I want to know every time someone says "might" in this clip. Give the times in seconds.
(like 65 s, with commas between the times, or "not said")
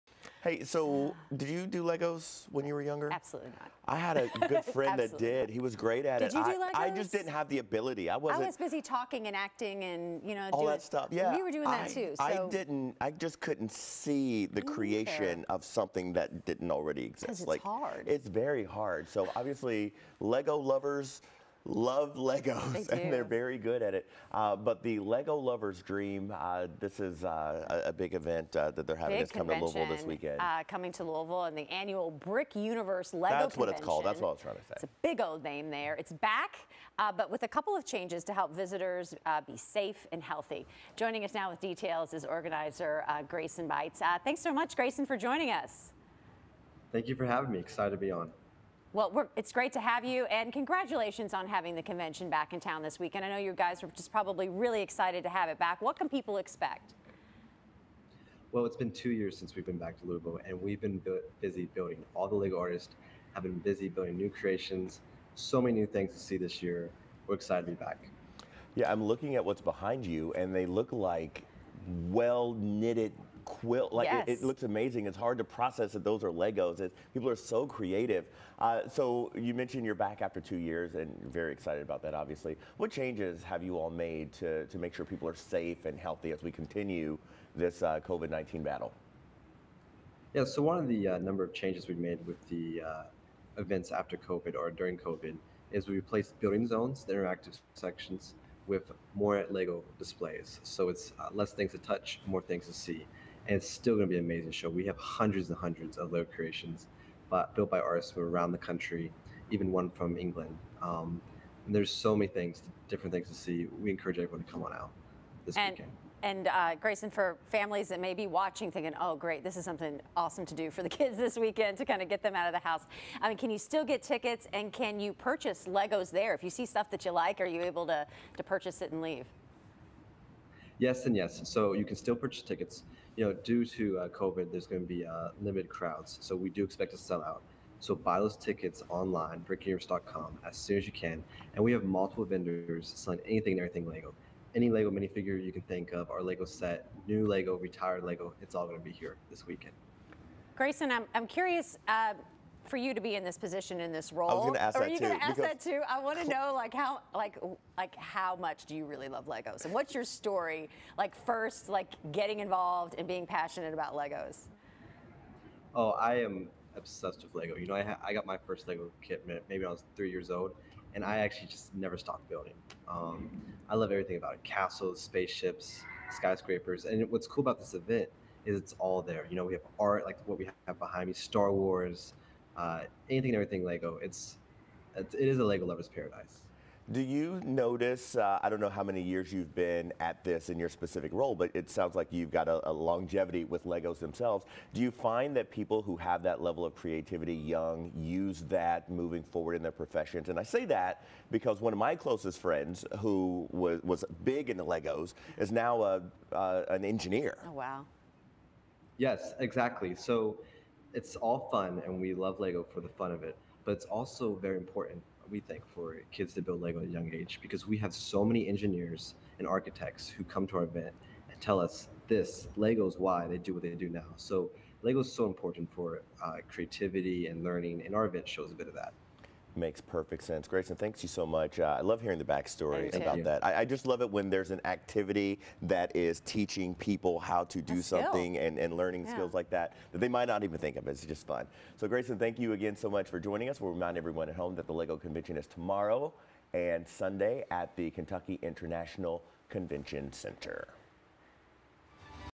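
240 s.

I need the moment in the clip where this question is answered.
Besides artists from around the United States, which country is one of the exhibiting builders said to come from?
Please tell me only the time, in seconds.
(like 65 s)
110 s.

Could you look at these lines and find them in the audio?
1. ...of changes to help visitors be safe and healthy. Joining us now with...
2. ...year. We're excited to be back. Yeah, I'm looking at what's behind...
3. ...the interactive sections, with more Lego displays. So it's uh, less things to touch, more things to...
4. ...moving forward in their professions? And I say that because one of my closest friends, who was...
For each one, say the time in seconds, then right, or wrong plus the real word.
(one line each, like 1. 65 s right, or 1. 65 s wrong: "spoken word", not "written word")
1. 37 s right
2. 66 s right
3. 97 s right
4. 198 s right.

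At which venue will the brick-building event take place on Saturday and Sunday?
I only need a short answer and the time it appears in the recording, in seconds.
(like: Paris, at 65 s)
Kentucky International Convention Center, at 247 s.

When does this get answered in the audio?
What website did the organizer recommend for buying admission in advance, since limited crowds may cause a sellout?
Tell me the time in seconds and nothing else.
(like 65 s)
139 s.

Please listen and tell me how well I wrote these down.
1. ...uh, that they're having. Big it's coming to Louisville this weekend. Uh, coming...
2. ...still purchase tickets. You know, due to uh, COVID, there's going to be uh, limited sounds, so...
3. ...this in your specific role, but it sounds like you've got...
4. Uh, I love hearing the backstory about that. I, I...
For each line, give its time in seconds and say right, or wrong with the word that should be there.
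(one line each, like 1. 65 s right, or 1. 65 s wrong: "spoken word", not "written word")
1. 28 s right
2. 131 s wrong: "crowds", not "sounds"
3. 190 s right
4. 231 s right.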